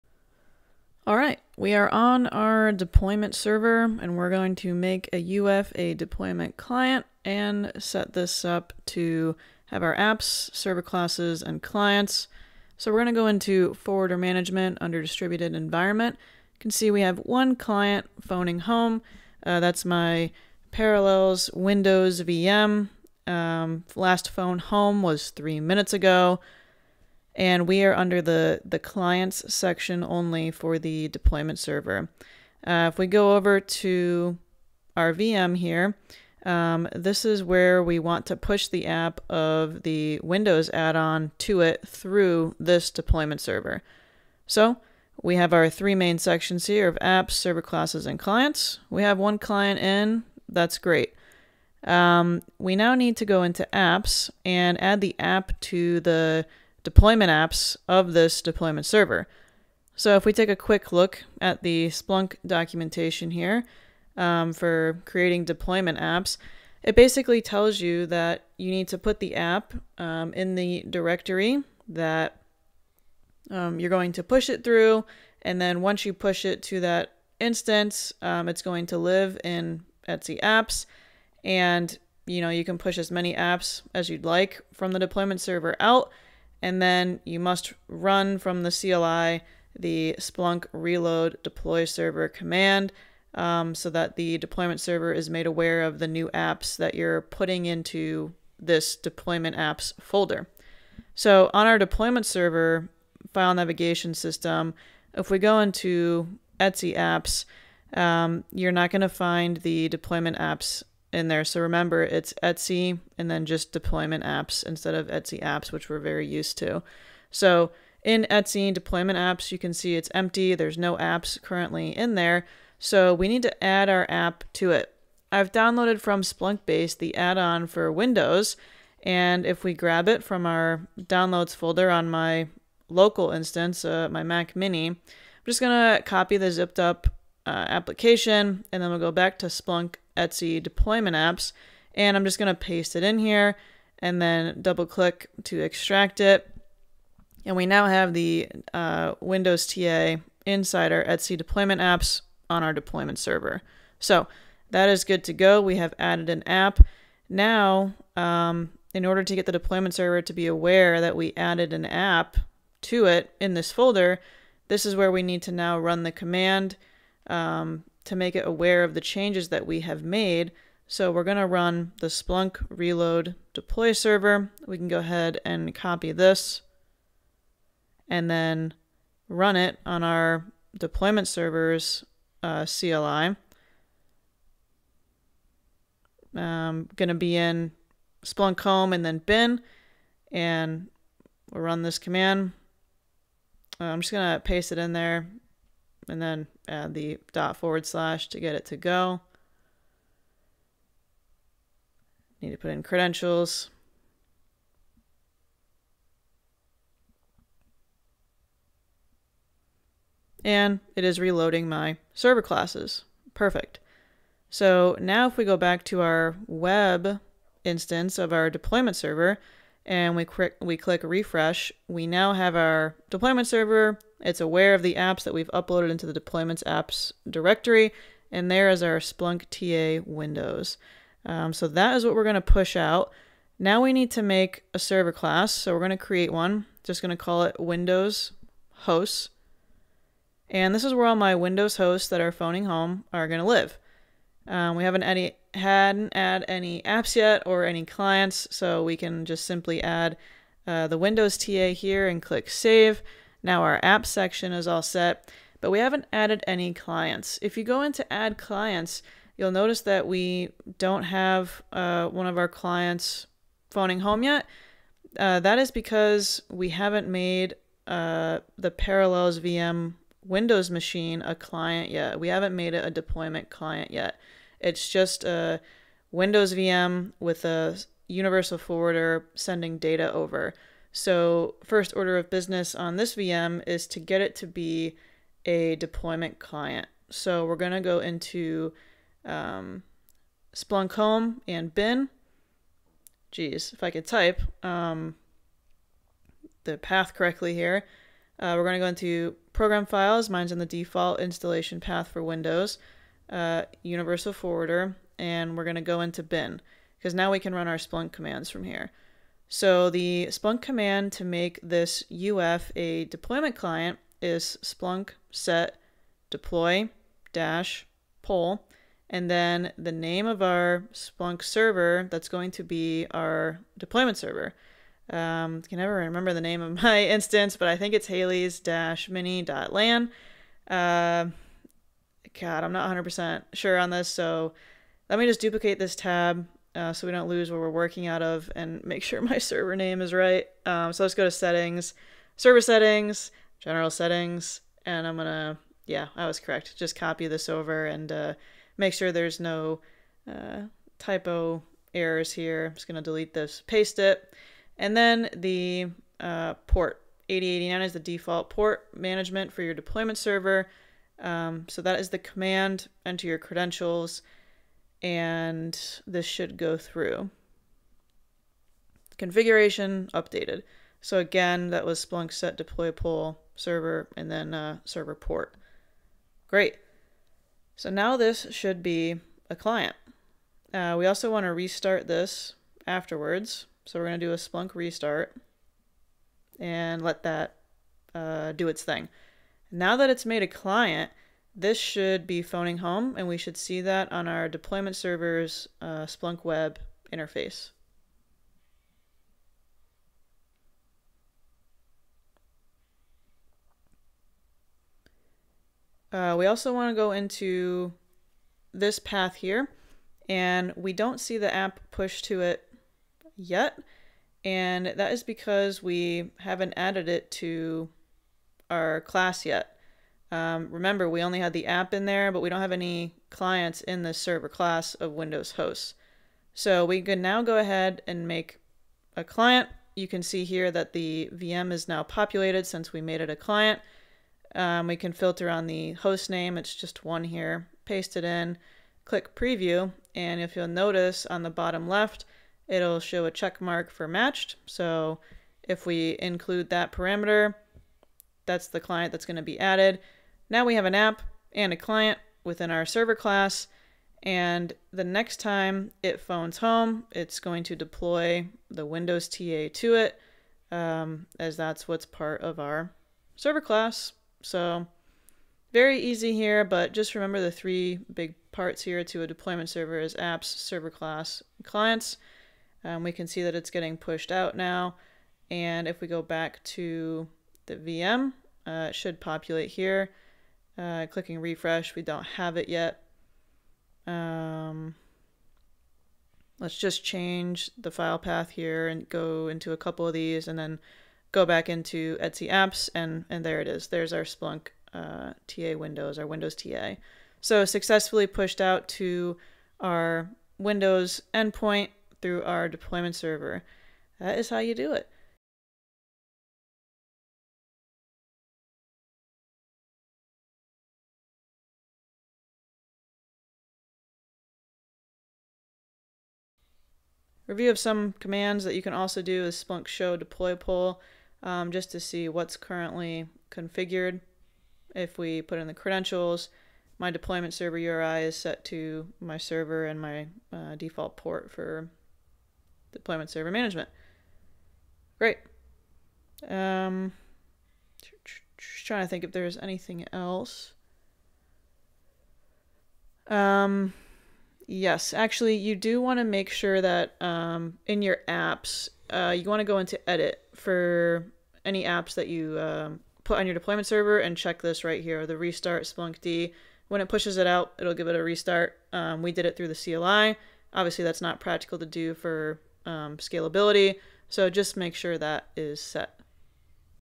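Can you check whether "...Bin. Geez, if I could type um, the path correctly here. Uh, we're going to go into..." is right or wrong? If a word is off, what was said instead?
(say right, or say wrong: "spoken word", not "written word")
right.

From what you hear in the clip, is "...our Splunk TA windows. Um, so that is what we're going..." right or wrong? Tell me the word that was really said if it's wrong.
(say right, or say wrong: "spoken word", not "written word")
right.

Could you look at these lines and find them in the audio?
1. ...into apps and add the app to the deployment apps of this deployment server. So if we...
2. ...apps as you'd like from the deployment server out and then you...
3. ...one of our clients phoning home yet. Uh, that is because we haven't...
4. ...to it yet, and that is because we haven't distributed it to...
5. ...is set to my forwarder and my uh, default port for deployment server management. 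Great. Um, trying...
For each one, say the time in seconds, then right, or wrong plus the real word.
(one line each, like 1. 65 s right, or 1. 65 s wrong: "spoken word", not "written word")
1. 53 s right
2. 83 s right
3. 262 s right
4. 412 s wrong: "added", not "distributed"
5. 528 s wrong: "server", not "forwarder".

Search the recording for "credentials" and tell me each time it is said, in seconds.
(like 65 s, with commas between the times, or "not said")
202 s, 363 s, 525 s.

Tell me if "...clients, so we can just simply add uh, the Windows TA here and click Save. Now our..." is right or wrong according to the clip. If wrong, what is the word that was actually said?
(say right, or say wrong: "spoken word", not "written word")
right.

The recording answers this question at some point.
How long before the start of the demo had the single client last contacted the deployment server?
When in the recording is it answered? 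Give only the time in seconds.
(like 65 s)
25 s.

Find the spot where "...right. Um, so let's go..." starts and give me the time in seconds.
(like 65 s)
340 s.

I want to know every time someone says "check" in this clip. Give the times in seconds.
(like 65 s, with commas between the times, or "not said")
443 s, 554 s.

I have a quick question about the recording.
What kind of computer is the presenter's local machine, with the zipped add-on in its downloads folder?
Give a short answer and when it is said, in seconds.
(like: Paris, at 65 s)
Mac mini, at 134 s.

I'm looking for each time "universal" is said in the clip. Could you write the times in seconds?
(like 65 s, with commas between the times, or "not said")
278 s, 303 s.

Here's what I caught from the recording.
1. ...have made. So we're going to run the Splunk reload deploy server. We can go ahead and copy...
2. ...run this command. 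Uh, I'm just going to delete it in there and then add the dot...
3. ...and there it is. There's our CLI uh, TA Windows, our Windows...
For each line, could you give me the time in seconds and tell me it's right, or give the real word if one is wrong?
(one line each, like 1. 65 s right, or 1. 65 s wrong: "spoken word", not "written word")
1. 169 s right
2. 191 s wrong: "paste", not "delete"
3. 493 s wrong: "Splunk", not "CLI".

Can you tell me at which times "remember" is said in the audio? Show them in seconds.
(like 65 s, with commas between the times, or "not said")
111 s, 325 s, 420 s, 467 s.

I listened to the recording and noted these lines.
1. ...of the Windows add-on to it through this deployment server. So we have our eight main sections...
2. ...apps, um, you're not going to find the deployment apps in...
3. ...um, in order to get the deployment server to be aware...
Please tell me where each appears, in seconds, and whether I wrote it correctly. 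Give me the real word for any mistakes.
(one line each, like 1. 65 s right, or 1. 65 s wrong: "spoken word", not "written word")
1. 39 s wrong: "three", not "eight"
2. 106 s right
3. 158 s right.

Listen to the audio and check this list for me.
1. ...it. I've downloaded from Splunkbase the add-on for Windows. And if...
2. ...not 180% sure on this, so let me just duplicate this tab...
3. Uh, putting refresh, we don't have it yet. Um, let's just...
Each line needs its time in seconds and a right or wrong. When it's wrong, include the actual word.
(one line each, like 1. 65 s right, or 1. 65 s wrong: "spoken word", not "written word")
1. 124 s right
2. 332 s wrong: "100", not "180"
3. 480 s wrong: "clicking", not "putting".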